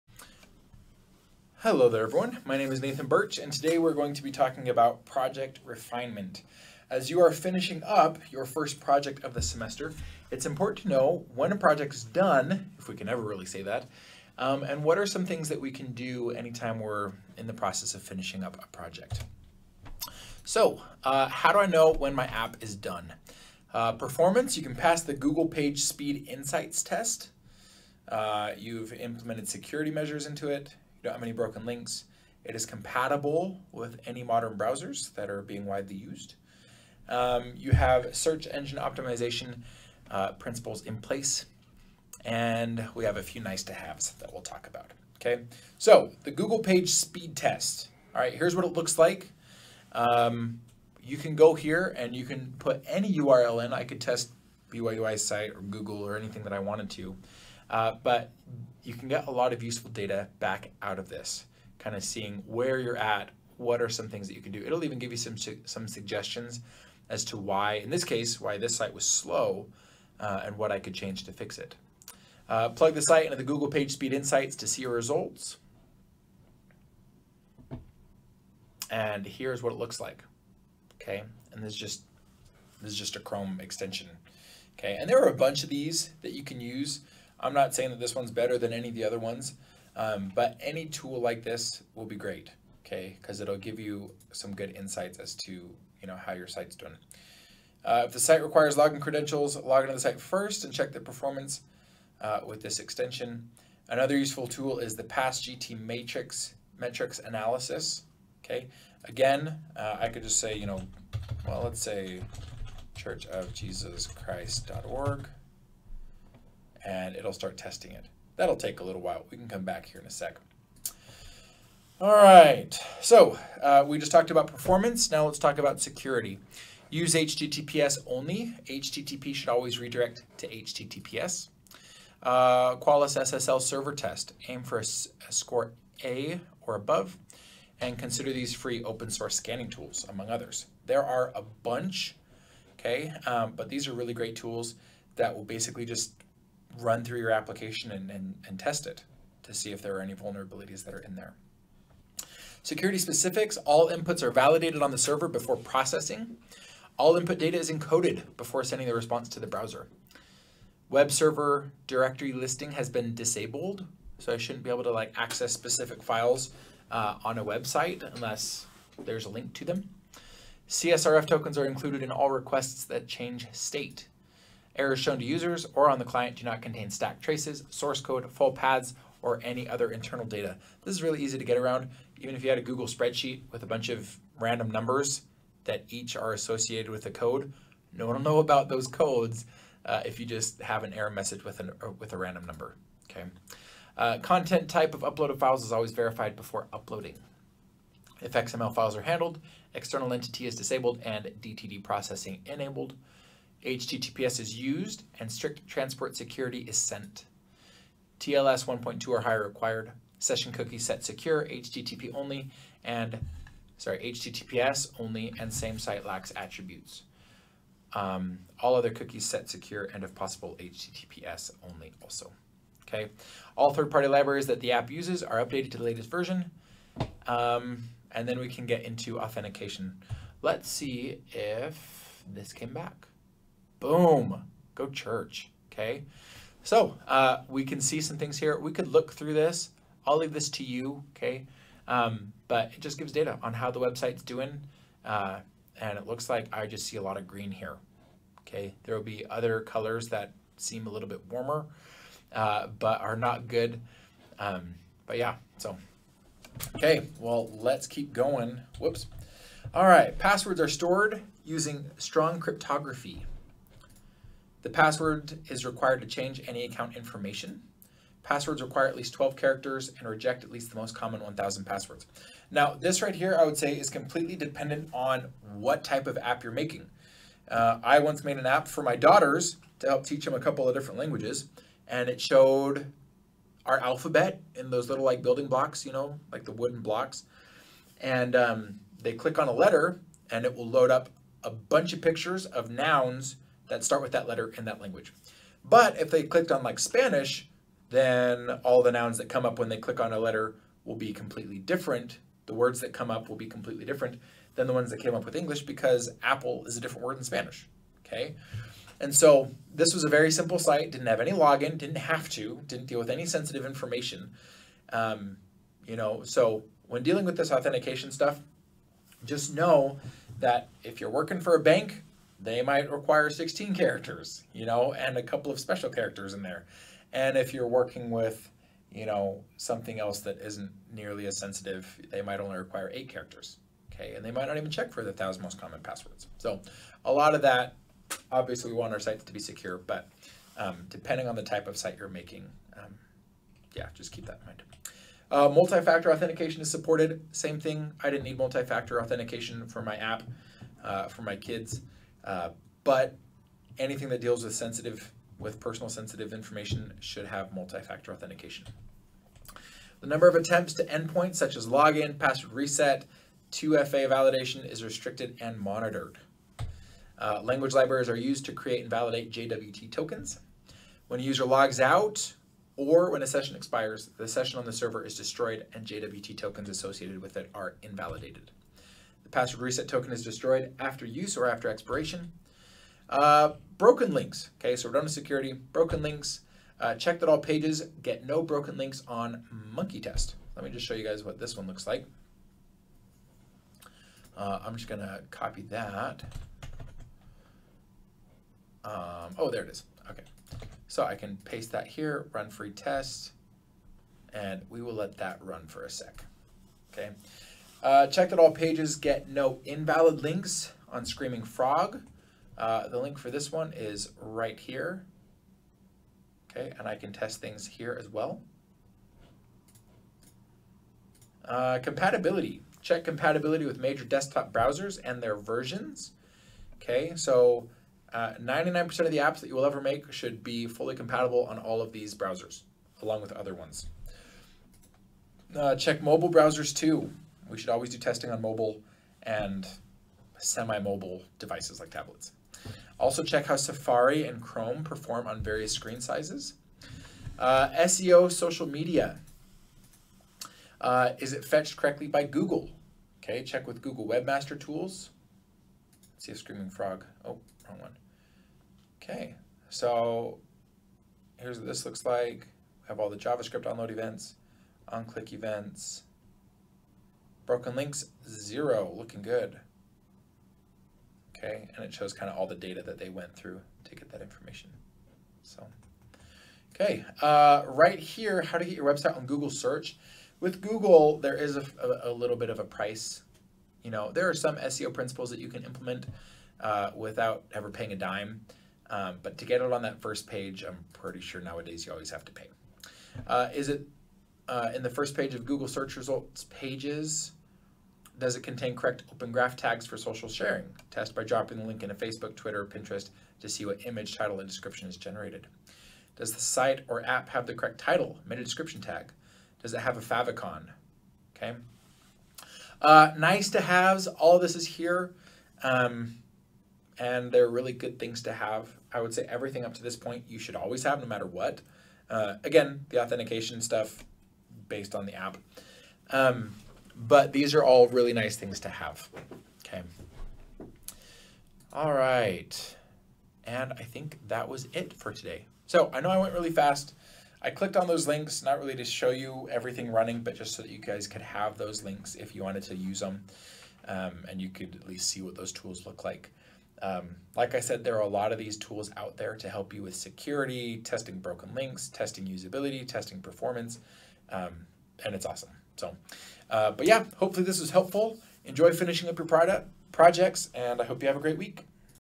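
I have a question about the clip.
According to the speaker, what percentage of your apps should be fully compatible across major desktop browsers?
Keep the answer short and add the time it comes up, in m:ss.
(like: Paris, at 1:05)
99%, at 7:08.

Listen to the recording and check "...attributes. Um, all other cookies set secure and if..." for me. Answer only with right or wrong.
right.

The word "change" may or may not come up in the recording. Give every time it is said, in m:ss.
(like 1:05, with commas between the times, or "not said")
1:10, 2:53, 4:26.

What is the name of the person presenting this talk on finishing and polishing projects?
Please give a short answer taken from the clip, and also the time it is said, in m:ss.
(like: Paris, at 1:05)
Nathan Birch, at 0:02.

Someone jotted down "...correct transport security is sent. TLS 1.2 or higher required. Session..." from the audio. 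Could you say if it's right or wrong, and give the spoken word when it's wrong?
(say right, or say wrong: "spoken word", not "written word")
wrong: "strict", not "correct".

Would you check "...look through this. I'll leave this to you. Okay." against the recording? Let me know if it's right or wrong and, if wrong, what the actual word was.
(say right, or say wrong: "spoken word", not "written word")
right.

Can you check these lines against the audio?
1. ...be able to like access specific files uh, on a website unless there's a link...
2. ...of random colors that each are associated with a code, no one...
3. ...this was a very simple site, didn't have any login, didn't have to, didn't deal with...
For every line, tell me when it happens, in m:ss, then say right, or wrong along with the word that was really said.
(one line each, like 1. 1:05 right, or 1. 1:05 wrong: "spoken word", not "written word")
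1. 2:44 right
2. 3:03 wrong: "numbers", not "colors"
3. 5:09 right.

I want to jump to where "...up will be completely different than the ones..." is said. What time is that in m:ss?
5:03.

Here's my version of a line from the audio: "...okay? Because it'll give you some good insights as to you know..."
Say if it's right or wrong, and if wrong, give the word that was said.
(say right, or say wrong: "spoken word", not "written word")
right.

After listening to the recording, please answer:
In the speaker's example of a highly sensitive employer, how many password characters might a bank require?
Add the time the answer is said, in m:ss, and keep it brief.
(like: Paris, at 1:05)
16, at 5:23.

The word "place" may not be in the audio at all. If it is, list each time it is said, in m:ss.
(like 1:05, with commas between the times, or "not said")
0:40.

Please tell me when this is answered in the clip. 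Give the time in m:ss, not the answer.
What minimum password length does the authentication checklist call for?
4:29.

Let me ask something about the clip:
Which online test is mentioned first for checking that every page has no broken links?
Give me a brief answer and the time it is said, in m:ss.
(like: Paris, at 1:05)
Monkey test, at 6:29.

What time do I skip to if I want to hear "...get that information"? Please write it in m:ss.
7:53.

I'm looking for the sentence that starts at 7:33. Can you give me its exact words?
Okay, check with Google Webmaster Tools.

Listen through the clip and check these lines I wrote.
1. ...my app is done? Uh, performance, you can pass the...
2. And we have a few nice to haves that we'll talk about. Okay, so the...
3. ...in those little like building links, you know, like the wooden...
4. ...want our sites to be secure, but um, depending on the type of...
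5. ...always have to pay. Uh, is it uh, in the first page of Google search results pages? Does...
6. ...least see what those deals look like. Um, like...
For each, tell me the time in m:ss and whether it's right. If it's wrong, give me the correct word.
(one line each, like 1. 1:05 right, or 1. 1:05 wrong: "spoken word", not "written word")
1. 0:22 right
2. 0:42 right
3. 4:44 wrong: "blocks", not "links"
4. 5:38 right
5. 8:11 right
6. 9:04 wrong: "tools", not "deals".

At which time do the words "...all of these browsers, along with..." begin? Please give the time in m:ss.
7:11.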